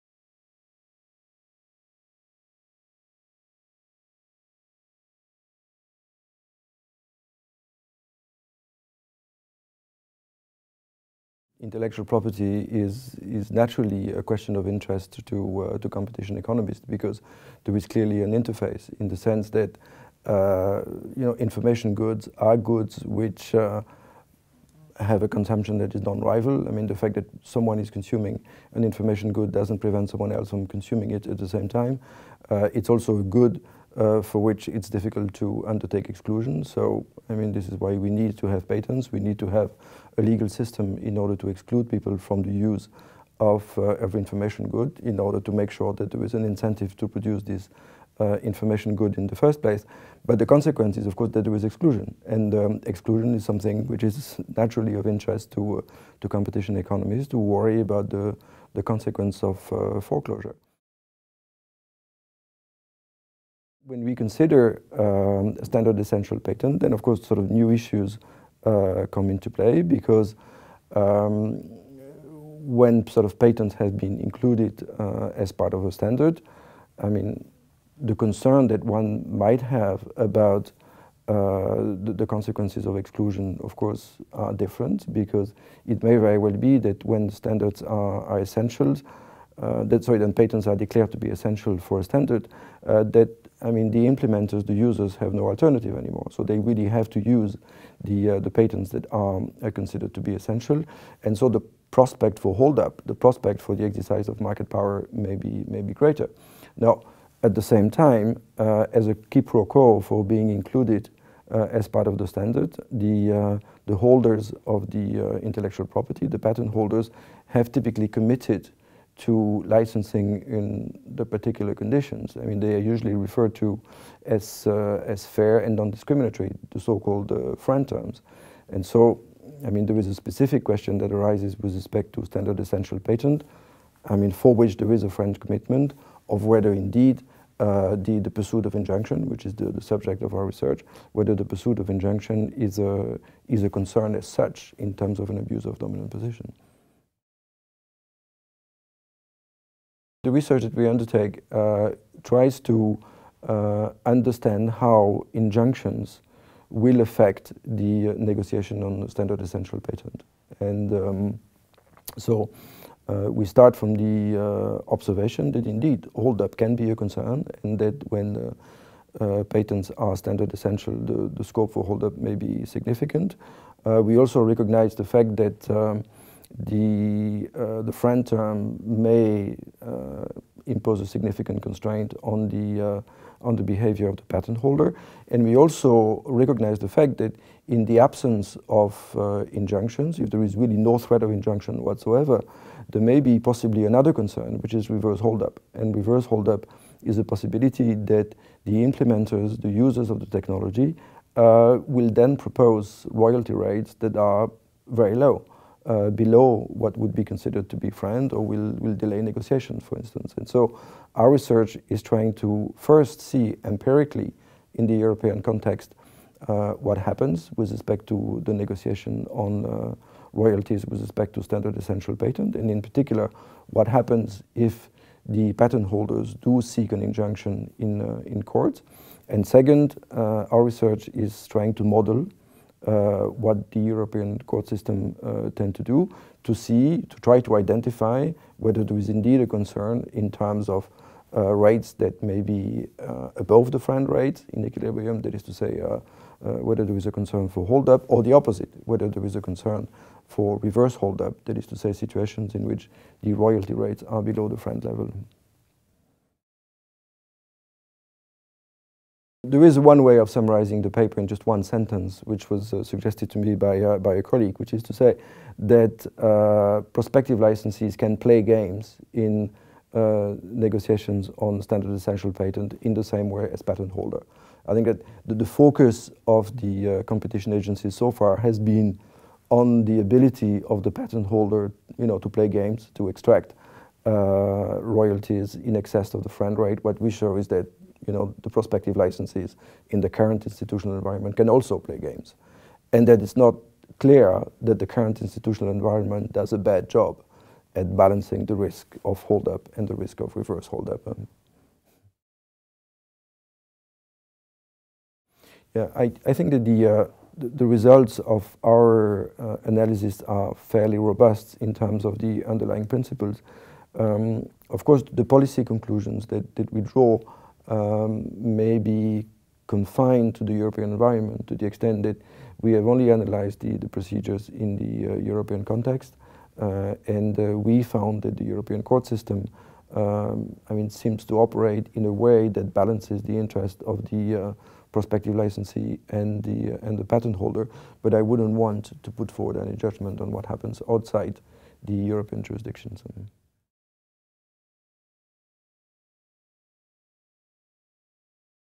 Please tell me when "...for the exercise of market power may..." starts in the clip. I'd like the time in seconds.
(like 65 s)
103 s.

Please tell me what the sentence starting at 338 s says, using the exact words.
But I wouldn't want to put forward any judgment on what happens outside the European jurisdictions.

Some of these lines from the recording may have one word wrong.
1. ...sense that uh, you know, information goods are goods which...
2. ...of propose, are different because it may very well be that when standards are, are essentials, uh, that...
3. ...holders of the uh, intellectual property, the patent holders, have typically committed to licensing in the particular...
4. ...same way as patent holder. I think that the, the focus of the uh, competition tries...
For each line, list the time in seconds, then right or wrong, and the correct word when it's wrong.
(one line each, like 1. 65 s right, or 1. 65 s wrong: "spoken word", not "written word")
1. 19 s right
2. 83 s wrong: "course", not "propose"
3. 113 s right
4. 273 s wrong: "agencies", not "tries".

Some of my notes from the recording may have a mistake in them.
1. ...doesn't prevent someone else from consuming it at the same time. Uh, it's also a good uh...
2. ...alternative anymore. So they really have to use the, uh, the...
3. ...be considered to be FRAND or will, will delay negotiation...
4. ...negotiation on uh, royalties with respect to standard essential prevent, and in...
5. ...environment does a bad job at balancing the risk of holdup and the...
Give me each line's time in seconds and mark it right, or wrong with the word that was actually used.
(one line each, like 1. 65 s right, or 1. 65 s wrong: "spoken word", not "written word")
1. 29 s right
2. 95 s right
3. 207 s right
4. 218 s wrong: "patent", not "prevent"
5. 295 s right.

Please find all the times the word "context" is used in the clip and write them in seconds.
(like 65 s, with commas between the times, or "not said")
215 s, 325 s.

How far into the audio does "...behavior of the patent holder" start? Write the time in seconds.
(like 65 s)
183 s.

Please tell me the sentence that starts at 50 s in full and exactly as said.
But the consequence is, of course, that there is exclusion.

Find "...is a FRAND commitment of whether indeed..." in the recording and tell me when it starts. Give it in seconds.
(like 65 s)
134 s.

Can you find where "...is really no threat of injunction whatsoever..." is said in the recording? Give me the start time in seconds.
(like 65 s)
190 s.